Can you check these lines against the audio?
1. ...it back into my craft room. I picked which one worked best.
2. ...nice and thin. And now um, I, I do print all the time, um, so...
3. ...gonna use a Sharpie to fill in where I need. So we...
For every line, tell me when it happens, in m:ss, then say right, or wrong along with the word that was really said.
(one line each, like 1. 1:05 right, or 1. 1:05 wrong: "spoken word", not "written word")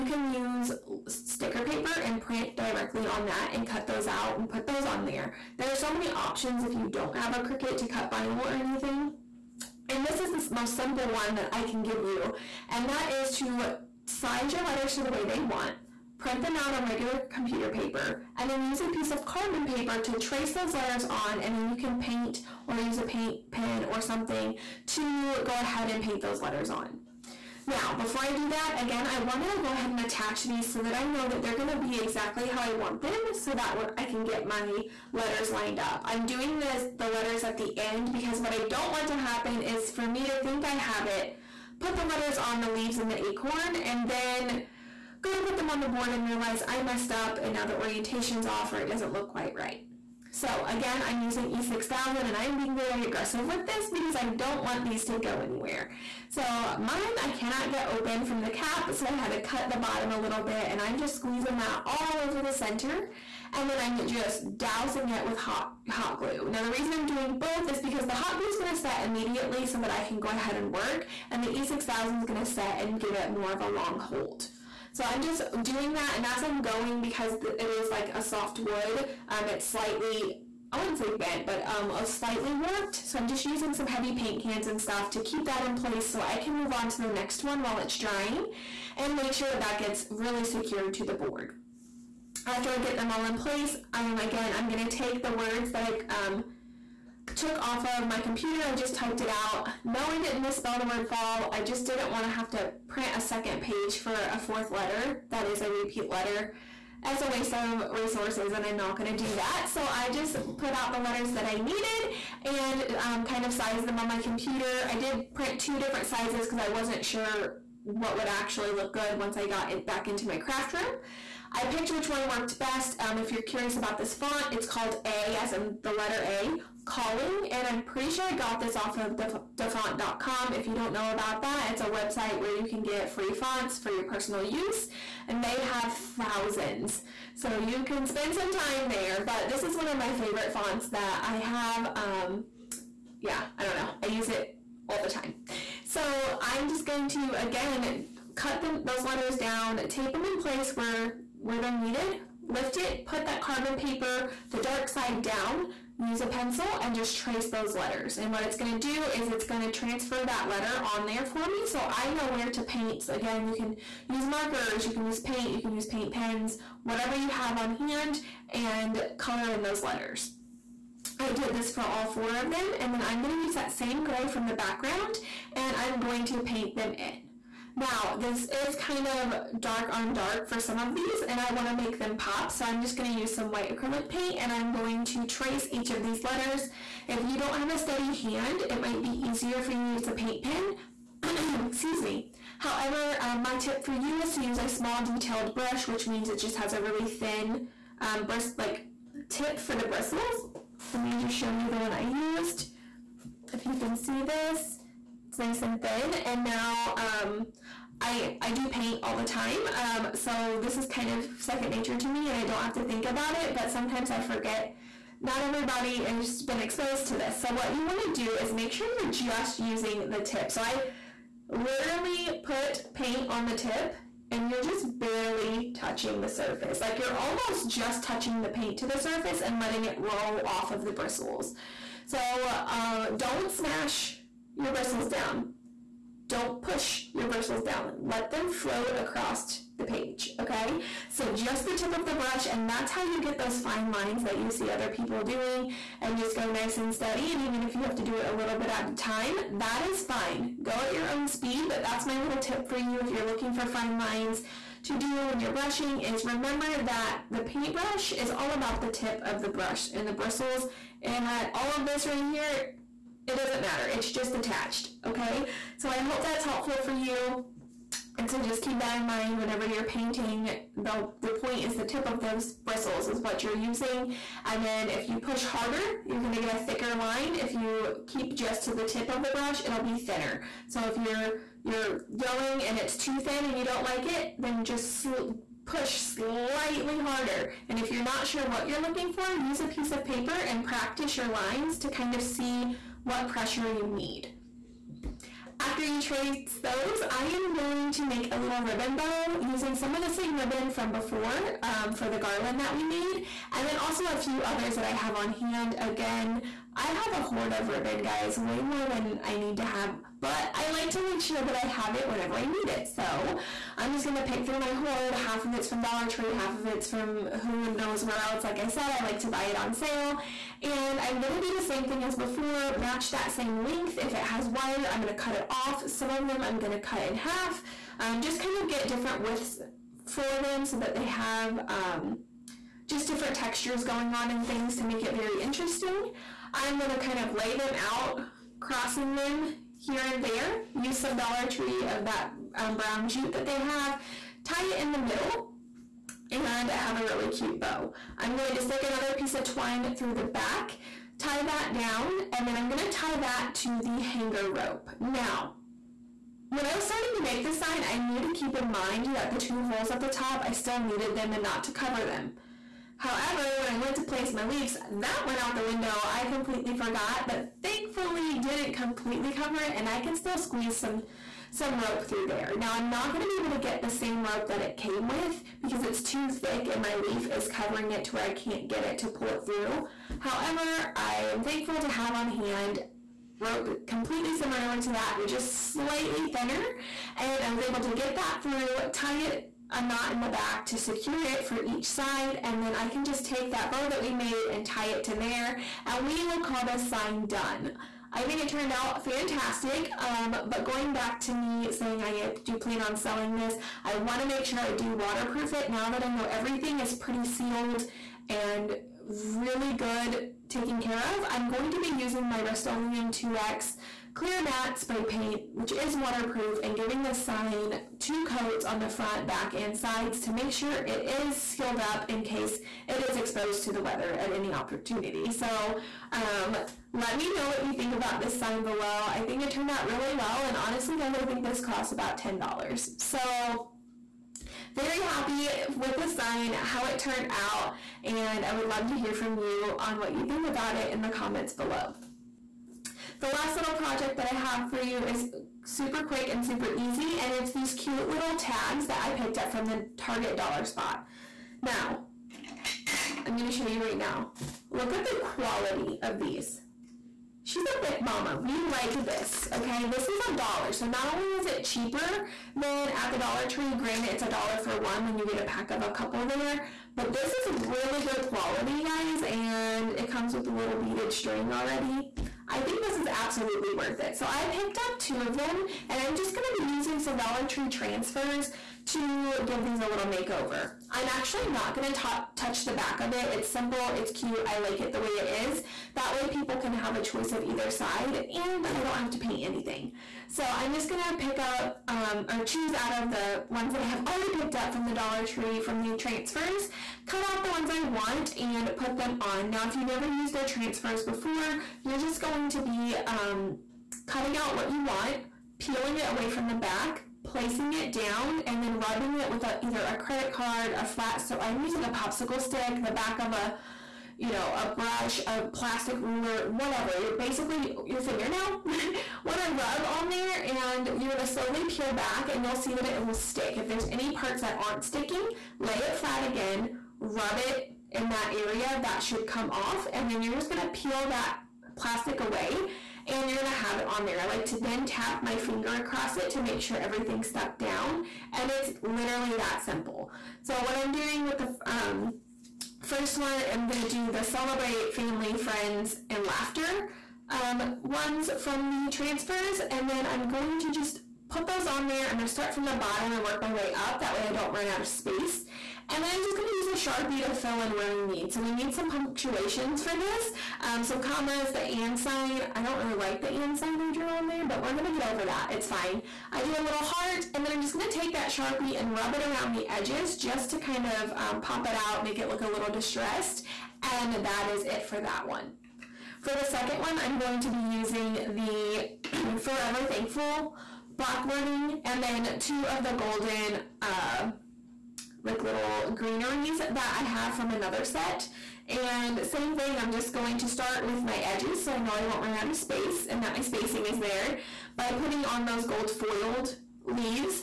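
1. 1:59 right
2. 3:25 wrong: "paint", not "print"
3. 9:16 right.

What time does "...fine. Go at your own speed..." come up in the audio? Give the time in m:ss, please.
4:10.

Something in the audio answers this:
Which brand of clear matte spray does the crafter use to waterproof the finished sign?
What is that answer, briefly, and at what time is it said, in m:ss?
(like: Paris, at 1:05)
Rust-Oleum, at 6:52.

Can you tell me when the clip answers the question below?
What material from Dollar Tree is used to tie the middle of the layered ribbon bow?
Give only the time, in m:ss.
5:42.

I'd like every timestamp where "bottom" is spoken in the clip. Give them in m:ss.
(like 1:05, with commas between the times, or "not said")
0:59, 9:12.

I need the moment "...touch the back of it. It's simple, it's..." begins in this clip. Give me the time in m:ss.
8:02.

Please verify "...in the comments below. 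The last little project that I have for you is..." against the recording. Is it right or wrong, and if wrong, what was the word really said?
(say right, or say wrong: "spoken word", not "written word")
right.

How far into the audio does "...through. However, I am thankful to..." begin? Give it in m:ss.
6:19.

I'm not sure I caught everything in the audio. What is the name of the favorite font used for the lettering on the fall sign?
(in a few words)
A Calling.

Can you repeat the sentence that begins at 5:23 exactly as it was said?
If it has wire, I'm gonna cut it off.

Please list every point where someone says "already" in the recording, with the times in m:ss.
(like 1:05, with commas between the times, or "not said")
7:51, 8:14.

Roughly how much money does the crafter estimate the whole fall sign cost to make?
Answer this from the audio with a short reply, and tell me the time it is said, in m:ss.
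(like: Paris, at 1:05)
$10, at 7:12.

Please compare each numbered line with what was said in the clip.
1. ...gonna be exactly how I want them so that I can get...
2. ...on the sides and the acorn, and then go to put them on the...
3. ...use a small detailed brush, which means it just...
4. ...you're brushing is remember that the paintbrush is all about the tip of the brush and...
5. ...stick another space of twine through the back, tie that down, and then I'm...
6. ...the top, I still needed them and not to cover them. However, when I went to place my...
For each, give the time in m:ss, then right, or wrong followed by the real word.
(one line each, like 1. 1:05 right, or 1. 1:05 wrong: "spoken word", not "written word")
1. 0:31 right
2. 0:42 wrong: "leaves", not "sides"
3. 3:14 right
4. 4:15 right
5. 5:48 wrong: "piece", not "space"
6. 5:59 right.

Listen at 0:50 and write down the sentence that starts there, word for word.
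So again, I'm using E6000 and I'm being very aggressive with this because I don't want these to go anywhere.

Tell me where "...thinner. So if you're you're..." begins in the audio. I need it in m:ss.
4:39.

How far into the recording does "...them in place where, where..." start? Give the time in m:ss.
2:30.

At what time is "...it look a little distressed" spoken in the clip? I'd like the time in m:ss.
9:32.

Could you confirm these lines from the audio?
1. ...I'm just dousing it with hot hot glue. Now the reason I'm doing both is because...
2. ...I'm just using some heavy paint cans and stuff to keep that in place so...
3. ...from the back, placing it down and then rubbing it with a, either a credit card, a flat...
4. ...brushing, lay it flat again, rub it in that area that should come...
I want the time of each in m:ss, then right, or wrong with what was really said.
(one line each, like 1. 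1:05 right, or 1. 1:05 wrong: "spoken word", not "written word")
1. 1:03 right
2. 1:23 right
3. 8:26 right
4. 8:44 wrong: "sticking", not "brushing".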